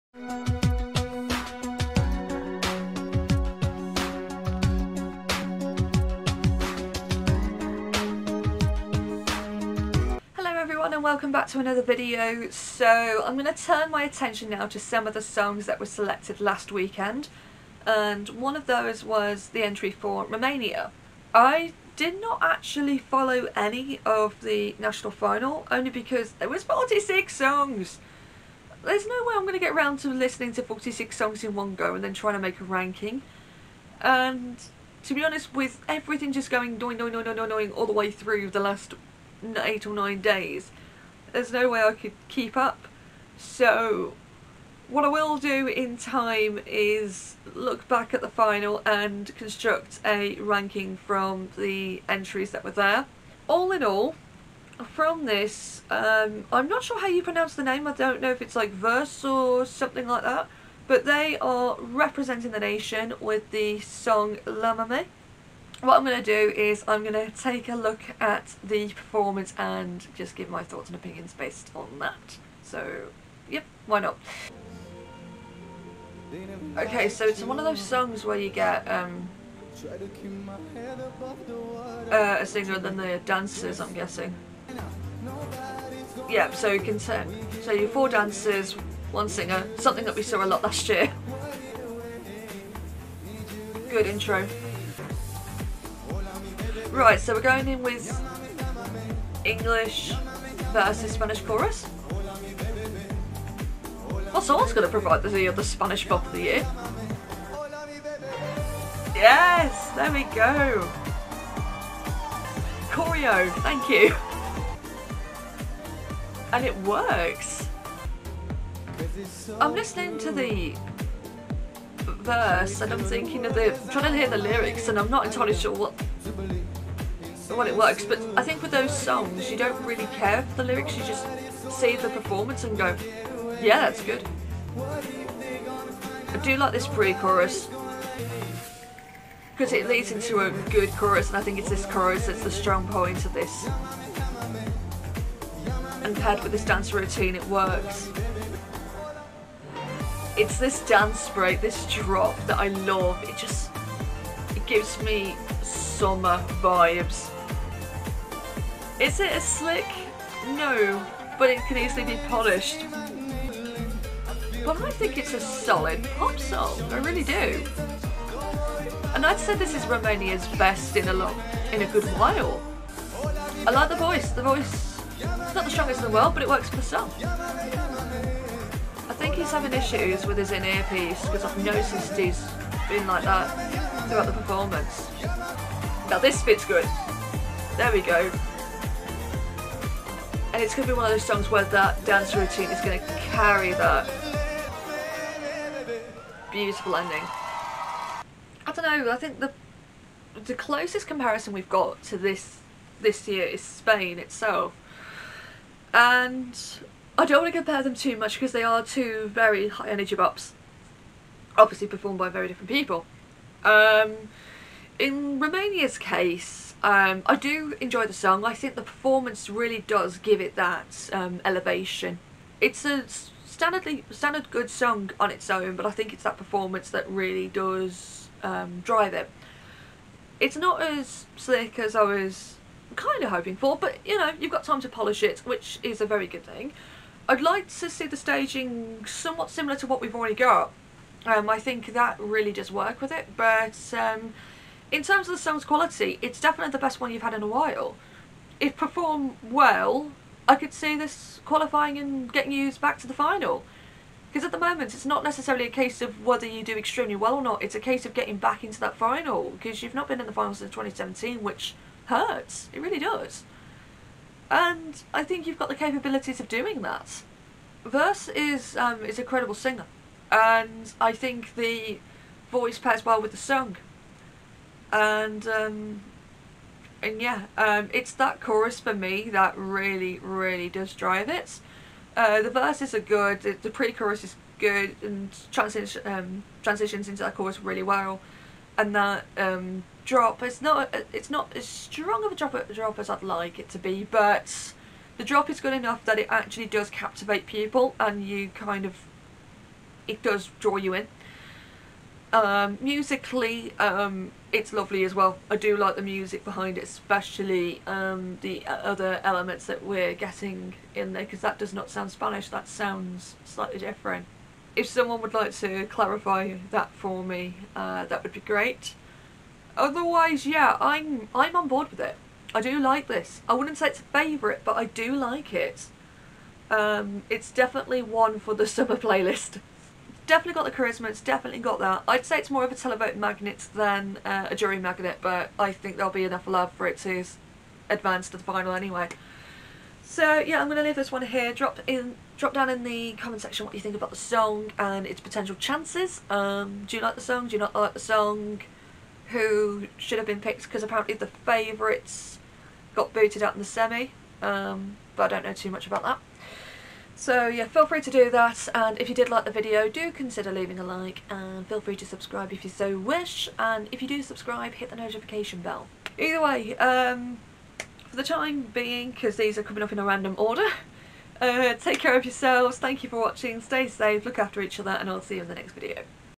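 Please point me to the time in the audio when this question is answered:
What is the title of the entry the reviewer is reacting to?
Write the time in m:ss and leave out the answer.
1:04.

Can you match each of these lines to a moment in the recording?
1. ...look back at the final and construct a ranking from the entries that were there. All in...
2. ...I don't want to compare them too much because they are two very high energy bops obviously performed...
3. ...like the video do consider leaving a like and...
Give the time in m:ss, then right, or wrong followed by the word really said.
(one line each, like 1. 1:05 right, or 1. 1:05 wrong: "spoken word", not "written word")
1. 0:47 right
2. 3:27 right
3. 5:59 right.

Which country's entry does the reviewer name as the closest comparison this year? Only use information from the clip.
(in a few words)
Spain.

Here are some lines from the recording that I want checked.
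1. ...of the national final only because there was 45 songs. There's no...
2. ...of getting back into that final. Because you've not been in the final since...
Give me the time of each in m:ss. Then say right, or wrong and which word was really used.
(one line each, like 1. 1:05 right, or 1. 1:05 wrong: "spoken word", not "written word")
1. 0:24 wrong: "46", not "45"
2. 4:18 right.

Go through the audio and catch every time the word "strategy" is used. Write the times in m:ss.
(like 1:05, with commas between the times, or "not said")
not said.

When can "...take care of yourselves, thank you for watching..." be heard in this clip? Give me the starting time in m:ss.
6:11.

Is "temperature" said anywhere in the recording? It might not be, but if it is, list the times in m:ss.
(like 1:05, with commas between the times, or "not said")
not said.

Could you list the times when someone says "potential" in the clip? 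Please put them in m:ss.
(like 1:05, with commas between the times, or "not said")
5:45.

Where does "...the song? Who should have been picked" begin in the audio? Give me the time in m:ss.
5:47.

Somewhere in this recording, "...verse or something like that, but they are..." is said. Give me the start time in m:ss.
0:58.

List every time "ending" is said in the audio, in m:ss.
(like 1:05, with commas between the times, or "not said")
3:16.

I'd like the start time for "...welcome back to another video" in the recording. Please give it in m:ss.
0:11.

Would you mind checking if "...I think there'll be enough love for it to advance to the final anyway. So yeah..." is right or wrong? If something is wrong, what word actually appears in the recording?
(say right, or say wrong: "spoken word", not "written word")
right.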